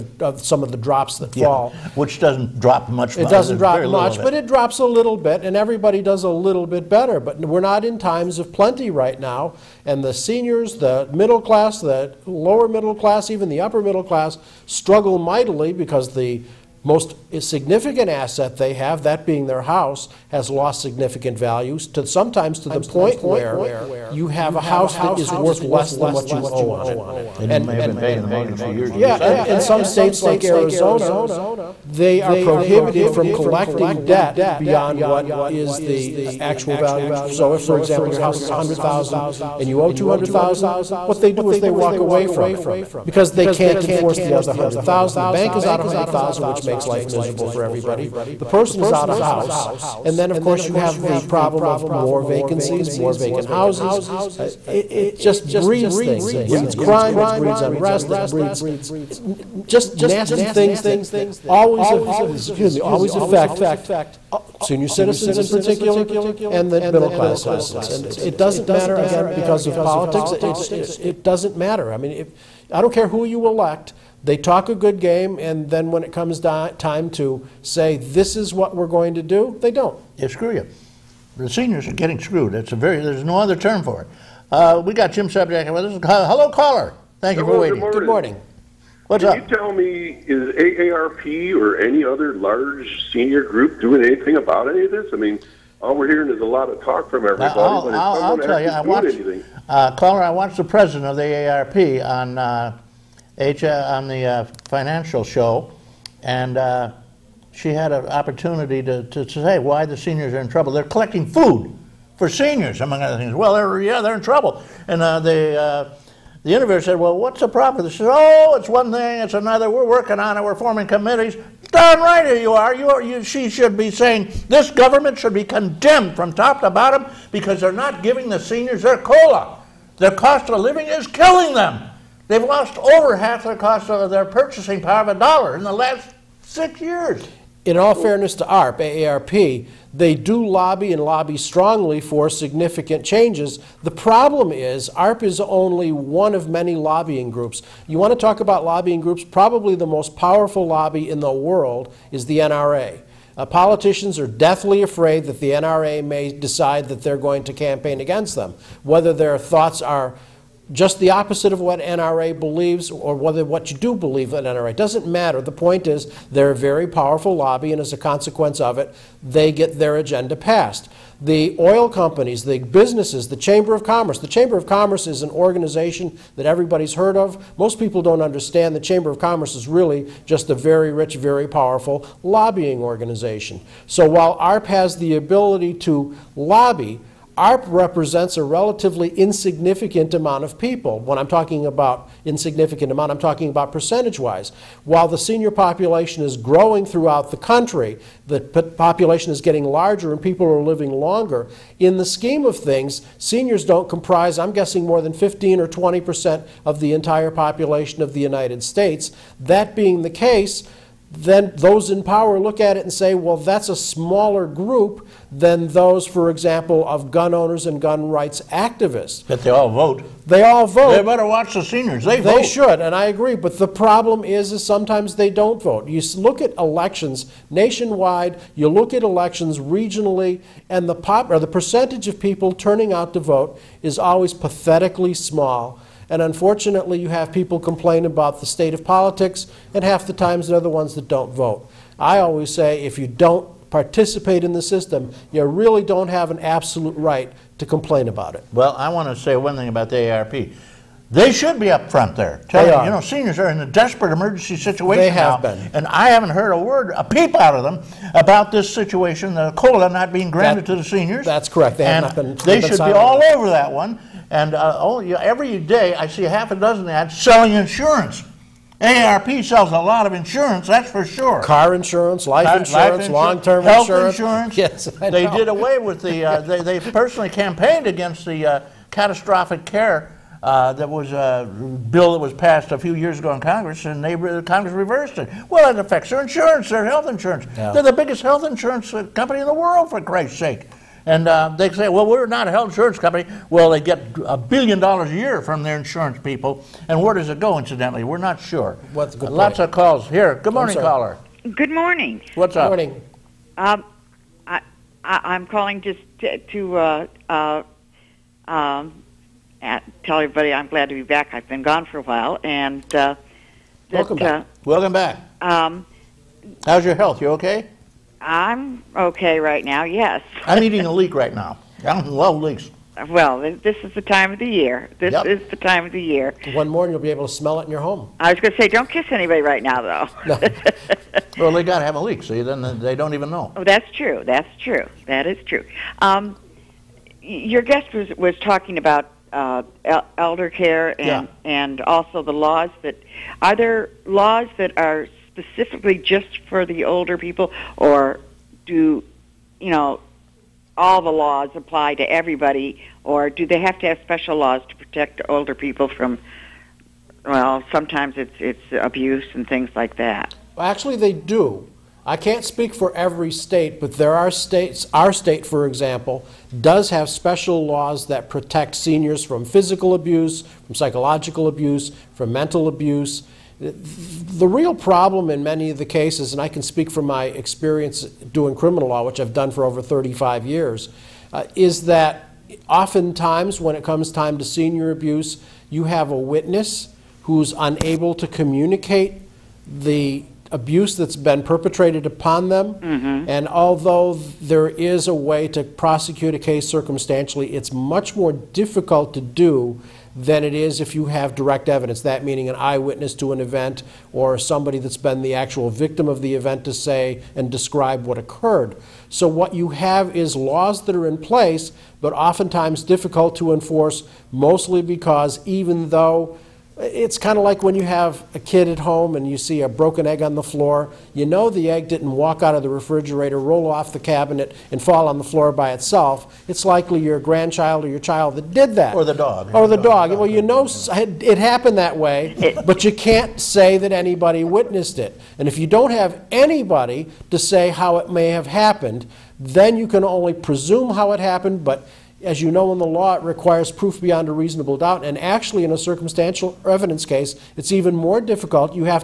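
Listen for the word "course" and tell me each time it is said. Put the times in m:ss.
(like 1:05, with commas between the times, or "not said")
0:50.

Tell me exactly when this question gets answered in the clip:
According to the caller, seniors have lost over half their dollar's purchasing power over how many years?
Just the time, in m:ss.
2:16.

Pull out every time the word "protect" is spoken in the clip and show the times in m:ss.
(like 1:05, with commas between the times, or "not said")
5:54, 6:08.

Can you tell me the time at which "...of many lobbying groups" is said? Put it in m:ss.
2:26.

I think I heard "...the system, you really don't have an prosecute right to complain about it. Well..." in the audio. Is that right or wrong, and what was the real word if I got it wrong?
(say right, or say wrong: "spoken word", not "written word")
wrong: "absolute", not "prosecute".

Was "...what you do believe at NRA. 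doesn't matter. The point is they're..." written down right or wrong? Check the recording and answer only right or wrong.
right.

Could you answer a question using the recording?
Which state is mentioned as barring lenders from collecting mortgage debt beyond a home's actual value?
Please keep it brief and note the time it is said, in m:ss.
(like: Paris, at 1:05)
Arizona, at 0:30.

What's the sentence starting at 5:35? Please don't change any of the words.
Um, your guest was was talking about uh, elder care and yeah.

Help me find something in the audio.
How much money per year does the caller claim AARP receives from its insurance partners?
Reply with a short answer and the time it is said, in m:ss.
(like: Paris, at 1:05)
a billion dollars, at 4:54.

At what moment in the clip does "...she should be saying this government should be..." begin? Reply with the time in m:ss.
2:03.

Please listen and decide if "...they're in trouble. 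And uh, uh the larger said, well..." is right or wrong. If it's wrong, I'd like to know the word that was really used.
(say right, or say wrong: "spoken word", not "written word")
wrong: "interviewer", not "larger".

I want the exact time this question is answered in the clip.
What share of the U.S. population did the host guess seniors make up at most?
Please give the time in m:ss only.
3:25.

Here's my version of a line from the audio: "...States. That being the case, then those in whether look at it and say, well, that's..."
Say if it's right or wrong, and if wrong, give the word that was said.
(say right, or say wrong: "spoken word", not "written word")
wrong: "power", not "whether".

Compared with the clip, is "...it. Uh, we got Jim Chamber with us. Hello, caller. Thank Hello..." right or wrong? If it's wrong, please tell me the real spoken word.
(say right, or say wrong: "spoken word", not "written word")
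wrong: "Subjack", not "Chamber".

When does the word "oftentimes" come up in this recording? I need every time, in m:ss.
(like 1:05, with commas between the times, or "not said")
6:22, 6:52.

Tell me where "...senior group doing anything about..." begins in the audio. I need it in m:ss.
1:33.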